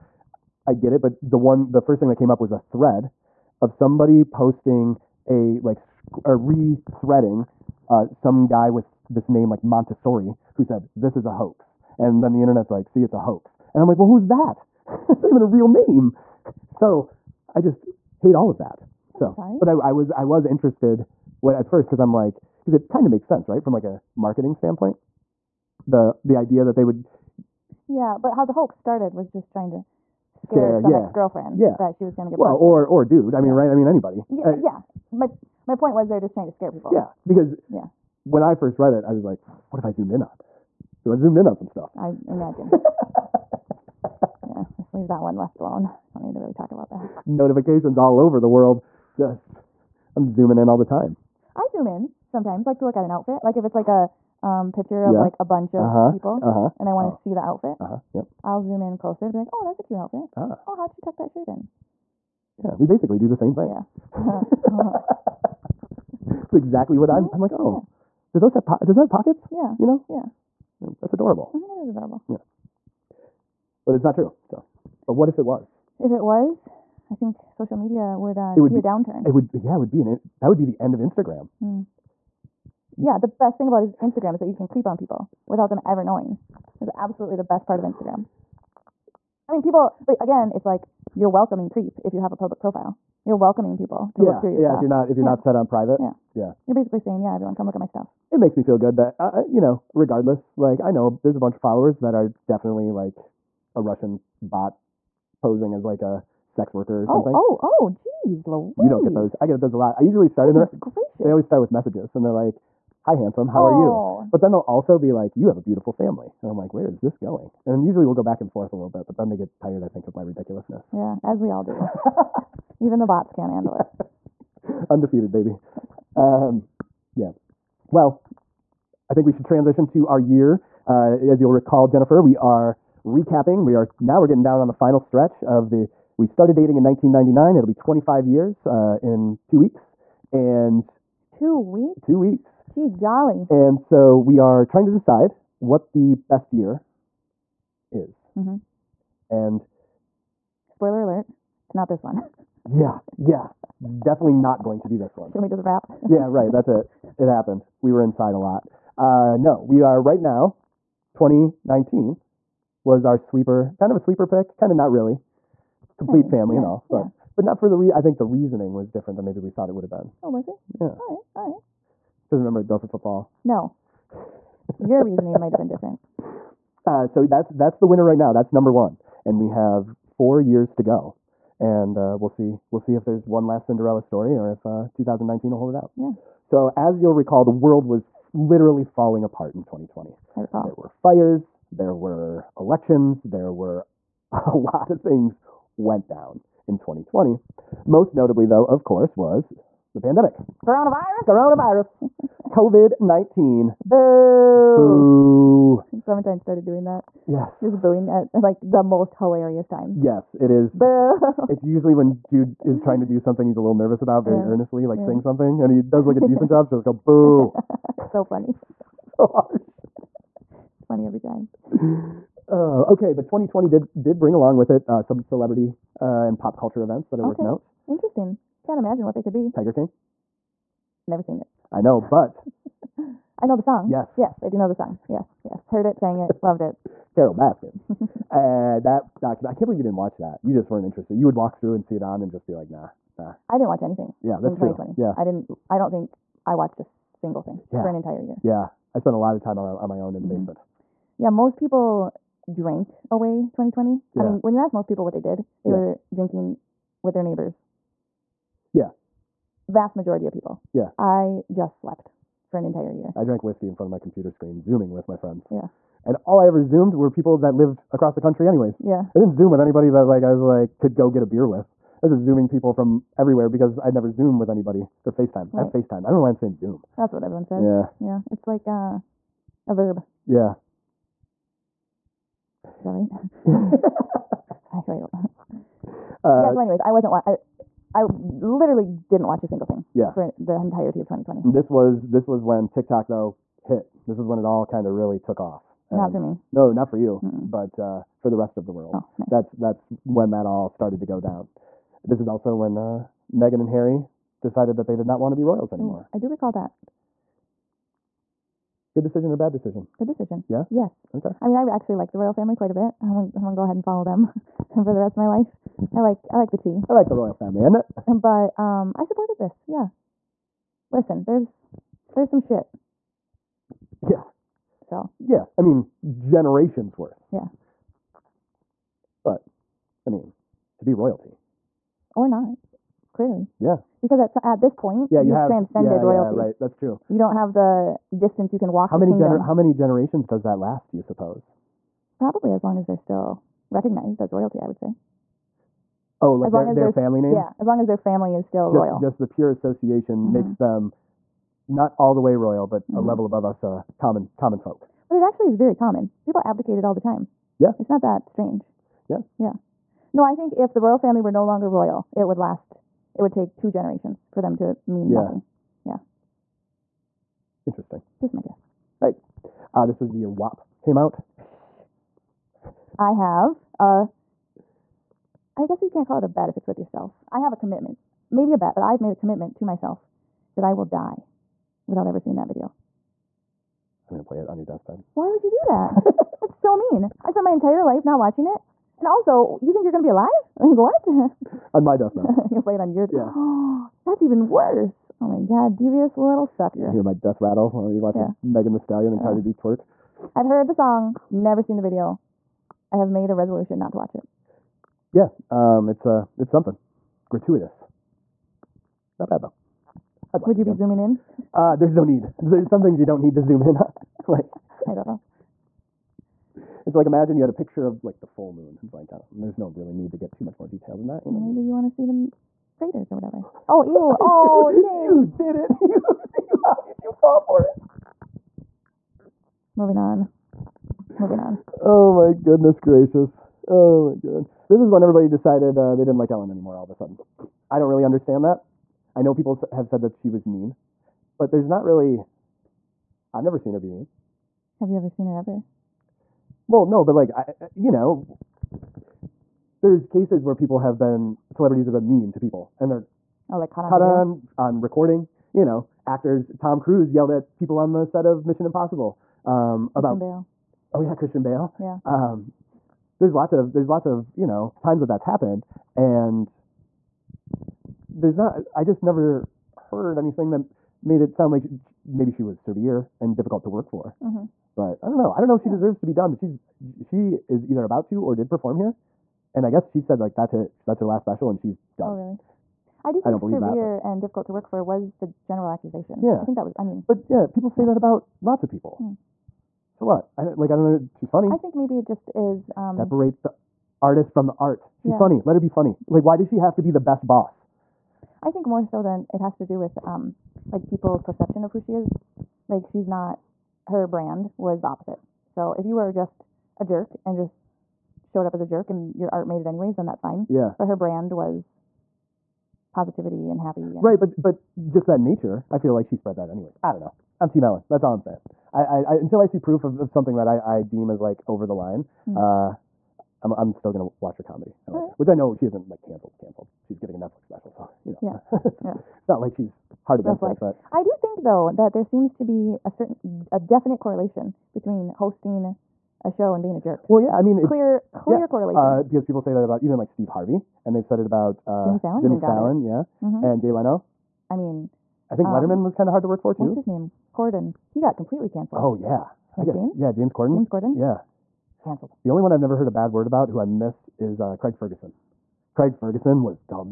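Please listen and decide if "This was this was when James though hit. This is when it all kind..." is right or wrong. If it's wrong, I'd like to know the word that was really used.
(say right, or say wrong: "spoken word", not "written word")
wrong: "TikTok", not "James".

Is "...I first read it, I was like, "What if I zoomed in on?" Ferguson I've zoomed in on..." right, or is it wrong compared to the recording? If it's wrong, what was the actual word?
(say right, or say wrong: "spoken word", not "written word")
wrong: "Because", not "Ferguson".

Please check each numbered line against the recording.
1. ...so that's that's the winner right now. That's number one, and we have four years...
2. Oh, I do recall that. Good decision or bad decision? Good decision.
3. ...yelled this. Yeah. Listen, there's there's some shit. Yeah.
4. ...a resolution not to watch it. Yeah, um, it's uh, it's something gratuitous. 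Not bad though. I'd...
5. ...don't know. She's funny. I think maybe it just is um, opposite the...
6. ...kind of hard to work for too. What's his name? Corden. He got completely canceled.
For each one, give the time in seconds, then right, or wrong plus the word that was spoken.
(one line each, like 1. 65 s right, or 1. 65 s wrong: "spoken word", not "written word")
1. 177 s right
2. 306 s right
3. 319 s wrong: "supported", not "yelled"
4. 403 s right
5. 490 s wrong: "separate", not "opposite"
6. 545 s right.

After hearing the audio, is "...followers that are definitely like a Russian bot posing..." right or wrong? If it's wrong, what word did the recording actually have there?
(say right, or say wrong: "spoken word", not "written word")
right.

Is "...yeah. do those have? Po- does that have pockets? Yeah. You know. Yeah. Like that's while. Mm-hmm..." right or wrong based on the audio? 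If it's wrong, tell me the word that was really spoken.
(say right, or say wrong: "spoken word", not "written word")
wrong: "adorable", not "while".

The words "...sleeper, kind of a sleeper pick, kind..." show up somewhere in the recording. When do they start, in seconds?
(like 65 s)
163 s.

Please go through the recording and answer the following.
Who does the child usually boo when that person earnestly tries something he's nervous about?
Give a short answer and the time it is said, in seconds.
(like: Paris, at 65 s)
Jude, at 212 s.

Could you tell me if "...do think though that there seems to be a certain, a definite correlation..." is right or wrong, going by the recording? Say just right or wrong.
right.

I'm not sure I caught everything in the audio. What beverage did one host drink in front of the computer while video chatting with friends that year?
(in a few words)
whiskey.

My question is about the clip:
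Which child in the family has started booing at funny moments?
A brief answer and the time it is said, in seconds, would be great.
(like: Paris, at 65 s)
Clementine, at 206 s.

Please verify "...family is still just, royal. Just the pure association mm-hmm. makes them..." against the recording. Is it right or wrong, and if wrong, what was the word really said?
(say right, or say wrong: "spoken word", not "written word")
right.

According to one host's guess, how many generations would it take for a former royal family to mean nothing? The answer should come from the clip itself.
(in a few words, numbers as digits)
2.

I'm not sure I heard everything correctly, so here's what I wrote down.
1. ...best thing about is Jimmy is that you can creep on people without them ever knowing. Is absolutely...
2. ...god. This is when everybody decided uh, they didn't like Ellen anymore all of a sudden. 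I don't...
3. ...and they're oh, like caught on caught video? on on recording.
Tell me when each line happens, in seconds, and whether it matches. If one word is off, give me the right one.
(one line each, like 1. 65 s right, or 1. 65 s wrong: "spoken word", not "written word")
1. 83 s wrong: "Instagram", not "Jimmy"
2. 434 s right
3. 452 s right.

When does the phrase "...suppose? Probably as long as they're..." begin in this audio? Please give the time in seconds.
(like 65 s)
340 s.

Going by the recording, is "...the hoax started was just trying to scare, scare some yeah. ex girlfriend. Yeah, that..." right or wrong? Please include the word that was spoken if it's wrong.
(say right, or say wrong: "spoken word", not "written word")
right.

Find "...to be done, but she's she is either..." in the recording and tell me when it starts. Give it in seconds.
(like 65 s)
476 s.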